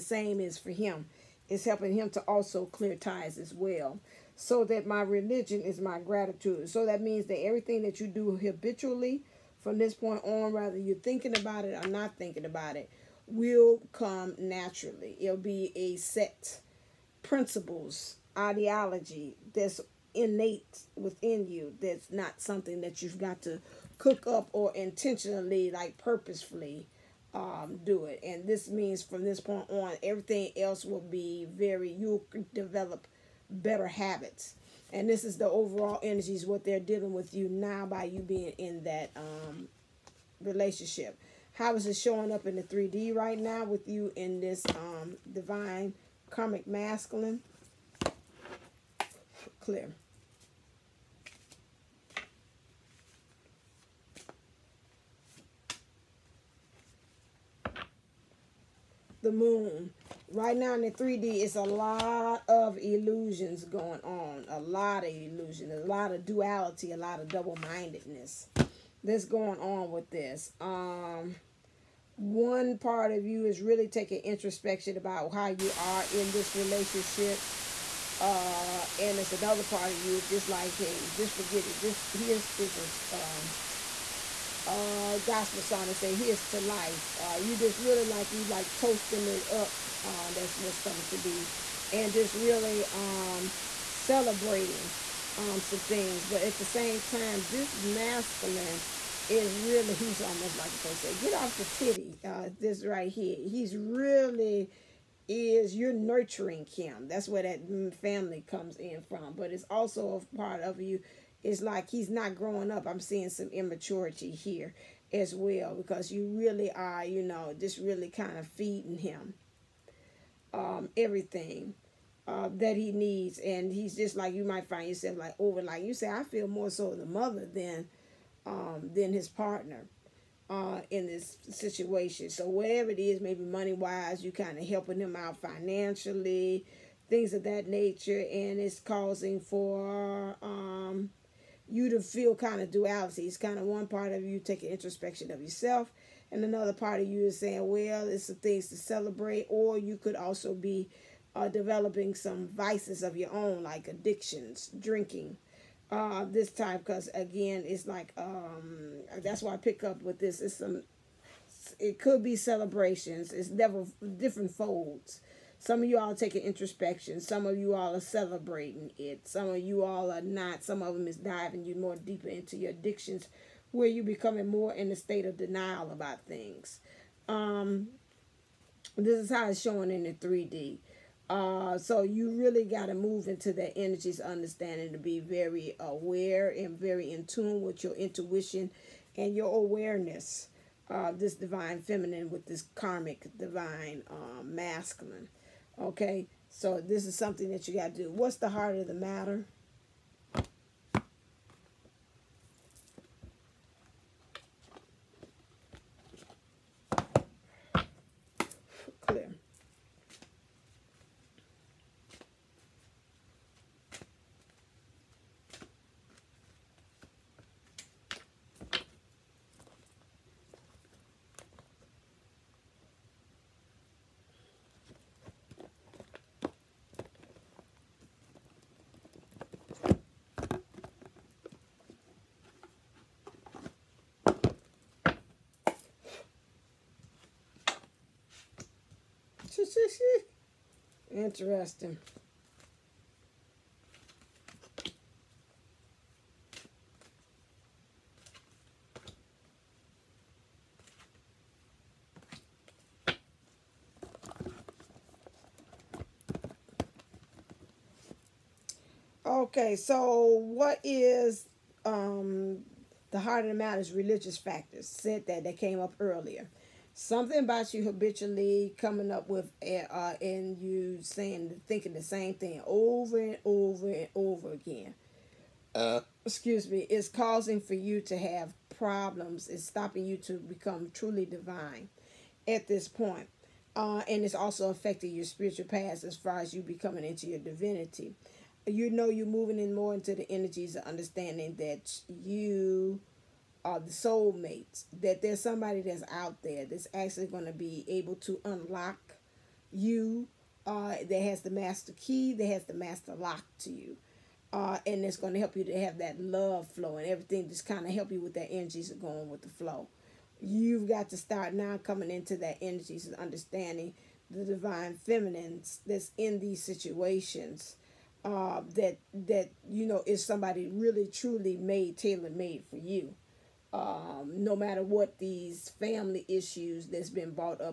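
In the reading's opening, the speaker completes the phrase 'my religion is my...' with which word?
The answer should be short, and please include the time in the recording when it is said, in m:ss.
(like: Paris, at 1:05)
gratitude, at 0:05.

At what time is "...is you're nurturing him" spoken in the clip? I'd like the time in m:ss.
1:45.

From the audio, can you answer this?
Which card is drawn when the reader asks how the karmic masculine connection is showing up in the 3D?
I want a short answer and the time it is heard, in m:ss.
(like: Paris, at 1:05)
The Moon, at 0:59.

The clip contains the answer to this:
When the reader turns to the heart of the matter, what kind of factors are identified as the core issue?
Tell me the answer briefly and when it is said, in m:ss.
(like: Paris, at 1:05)
religious factors, at 4:23.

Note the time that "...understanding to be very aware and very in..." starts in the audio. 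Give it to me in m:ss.
3:04.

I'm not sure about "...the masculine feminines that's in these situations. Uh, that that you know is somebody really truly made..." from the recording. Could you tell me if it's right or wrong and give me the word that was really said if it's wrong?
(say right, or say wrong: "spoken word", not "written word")
wrong: "divine", not "masculine".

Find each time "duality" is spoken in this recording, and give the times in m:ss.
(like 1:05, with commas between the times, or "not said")
1:06, 2:22.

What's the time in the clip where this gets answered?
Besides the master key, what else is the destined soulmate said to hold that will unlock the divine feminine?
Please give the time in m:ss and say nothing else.
5:02.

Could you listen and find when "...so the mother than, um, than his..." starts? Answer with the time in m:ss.
2:06.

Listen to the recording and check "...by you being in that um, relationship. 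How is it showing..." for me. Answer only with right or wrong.
right.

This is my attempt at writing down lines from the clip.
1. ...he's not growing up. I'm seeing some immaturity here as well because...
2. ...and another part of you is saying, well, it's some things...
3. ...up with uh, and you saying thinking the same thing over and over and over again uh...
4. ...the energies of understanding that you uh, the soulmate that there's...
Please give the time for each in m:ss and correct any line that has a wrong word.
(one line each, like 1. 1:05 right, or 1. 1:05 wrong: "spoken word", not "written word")
1. 1:51 right
2. 2:26 right
3. 4:29 right
4. 4:50 right.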